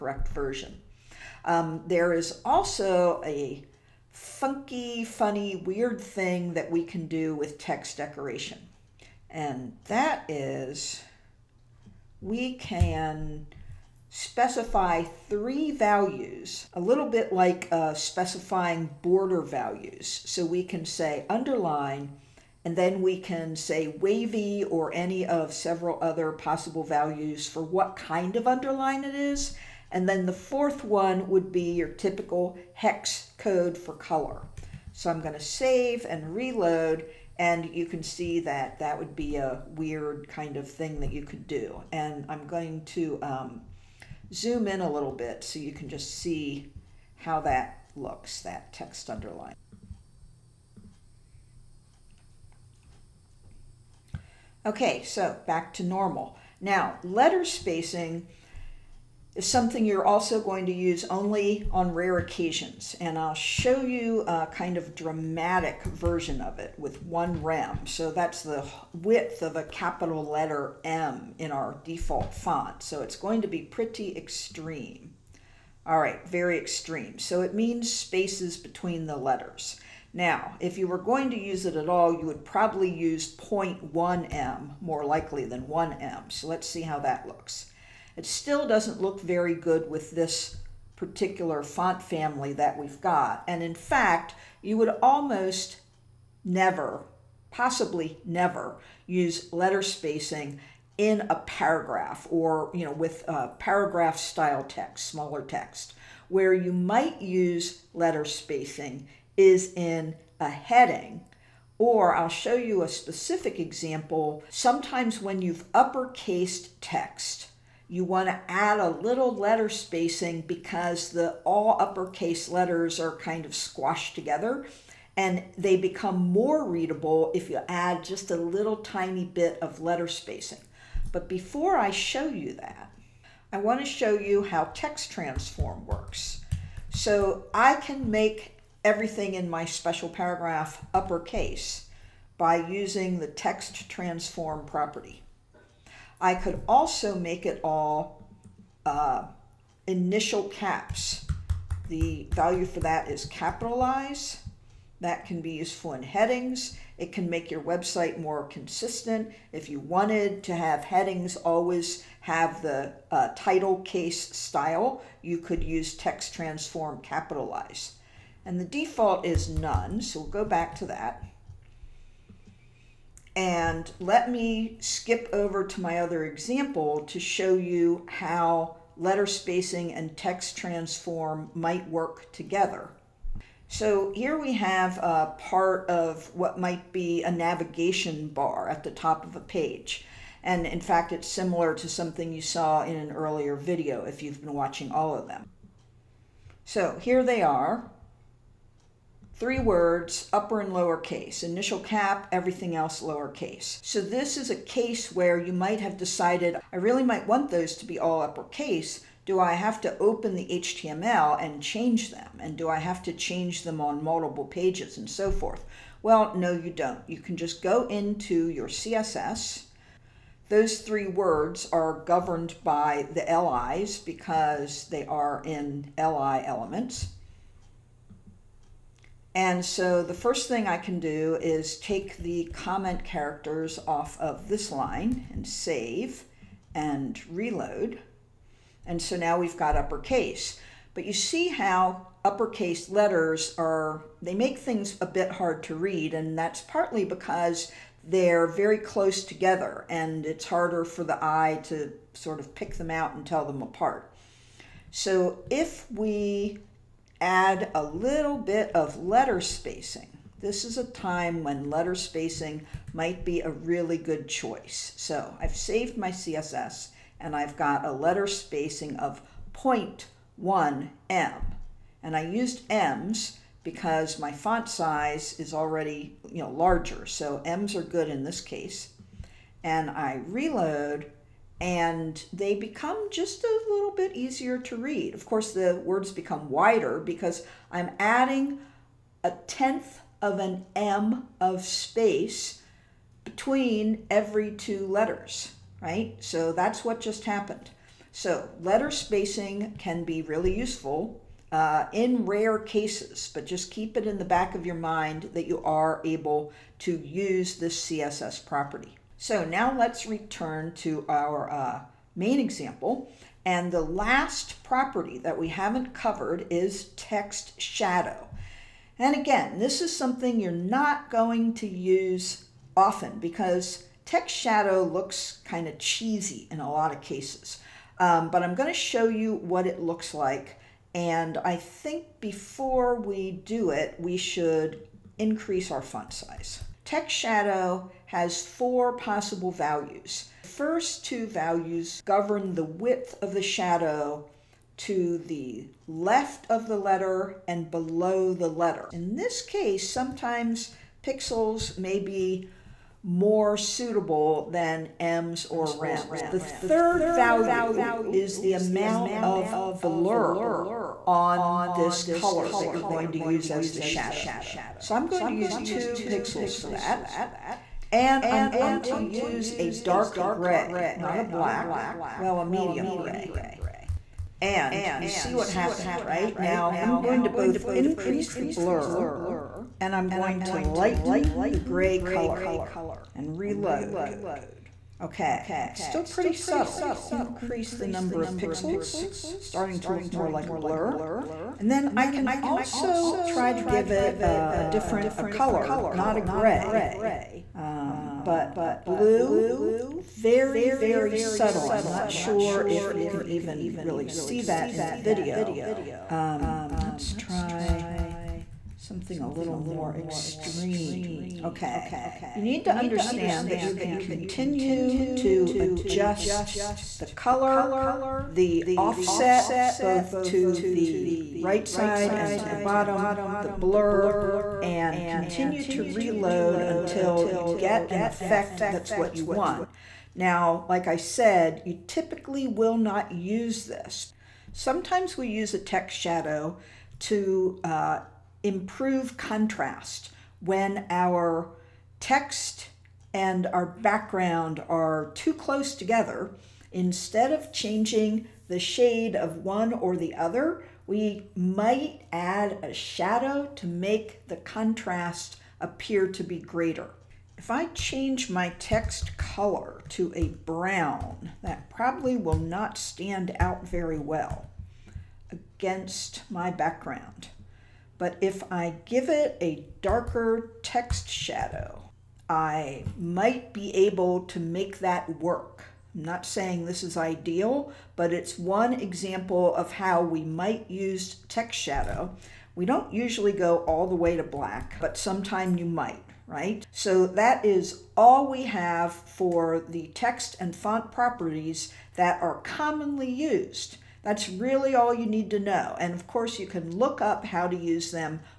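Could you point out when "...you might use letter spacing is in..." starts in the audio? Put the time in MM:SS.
01:46.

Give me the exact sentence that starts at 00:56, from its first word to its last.
Now, letter spacing is something you're also going to use only on rare occasions.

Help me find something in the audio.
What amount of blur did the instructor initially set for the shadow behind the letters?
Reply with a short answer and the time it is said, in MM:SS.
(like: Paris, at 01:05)
2 pixels, at 06:05.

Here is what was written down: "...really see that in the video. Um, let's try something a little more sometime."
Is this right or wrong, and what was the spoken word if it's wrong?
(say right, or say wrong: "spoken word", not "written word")
wrong: "extreme", not "sometime".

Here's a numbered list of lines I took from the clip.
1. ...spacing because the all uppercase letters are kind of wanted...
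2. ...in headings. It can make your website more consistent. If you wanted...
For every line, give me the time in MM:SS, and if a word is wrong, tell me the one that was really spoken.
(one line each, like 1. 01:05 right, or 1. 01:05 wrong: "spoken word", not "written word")
1. 01:59 wrong: "squashed", not "wanted"
2. 02:35 right.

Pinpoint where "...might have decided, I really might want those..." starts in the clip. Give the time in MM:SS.
03:25.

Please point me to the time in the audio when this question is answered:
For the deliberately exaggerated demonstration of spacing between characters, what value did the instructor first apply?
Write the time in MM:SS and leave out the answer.
01:07.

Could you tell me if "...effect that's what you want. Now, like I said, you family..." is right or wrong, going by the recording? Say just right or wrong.
wrong.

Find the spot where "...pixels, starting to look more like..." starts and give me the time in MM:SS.
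06:28.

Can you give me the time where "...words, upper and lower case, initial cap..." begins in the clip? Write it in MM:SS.
03:19.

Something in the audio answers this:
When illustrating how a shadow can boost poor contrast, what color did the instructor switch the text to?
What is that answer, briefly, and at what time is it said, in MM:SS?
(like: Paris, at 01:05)
brown, at 07:40.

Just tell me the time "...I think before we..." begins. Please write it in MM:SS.
05:31.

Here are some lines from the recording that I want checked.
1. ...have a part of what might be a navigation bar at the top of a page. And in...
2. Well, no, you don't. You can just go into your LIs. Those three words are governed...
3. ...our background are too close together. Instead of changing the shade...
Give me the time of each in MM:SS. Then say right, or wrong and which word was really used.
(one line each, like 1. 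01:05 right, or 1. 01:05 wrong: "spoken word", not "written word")
1. 03:04 right
2. 03:36 wrong: "CSS", not "LIs"
3. 07:23 right.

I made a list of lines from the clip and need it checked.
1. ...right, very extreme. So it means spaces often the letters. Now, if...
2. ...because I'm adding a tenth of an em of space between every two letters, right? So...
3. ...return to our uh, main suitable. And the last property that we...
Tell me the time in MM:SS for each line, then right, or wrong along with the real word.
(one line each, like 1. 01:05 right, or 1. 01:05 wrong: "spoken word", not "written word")
1. 01:15 wrong: "between", not "often"
2. 04:46 right
3. 05:10 wrong: "example", not "suitable".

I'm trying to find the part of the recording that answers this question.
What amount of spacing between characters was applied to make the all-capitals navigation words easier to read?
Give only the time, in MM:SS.
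04:29.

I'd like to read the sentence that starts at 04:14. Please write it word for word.
So if we add a little bit of letter spacing.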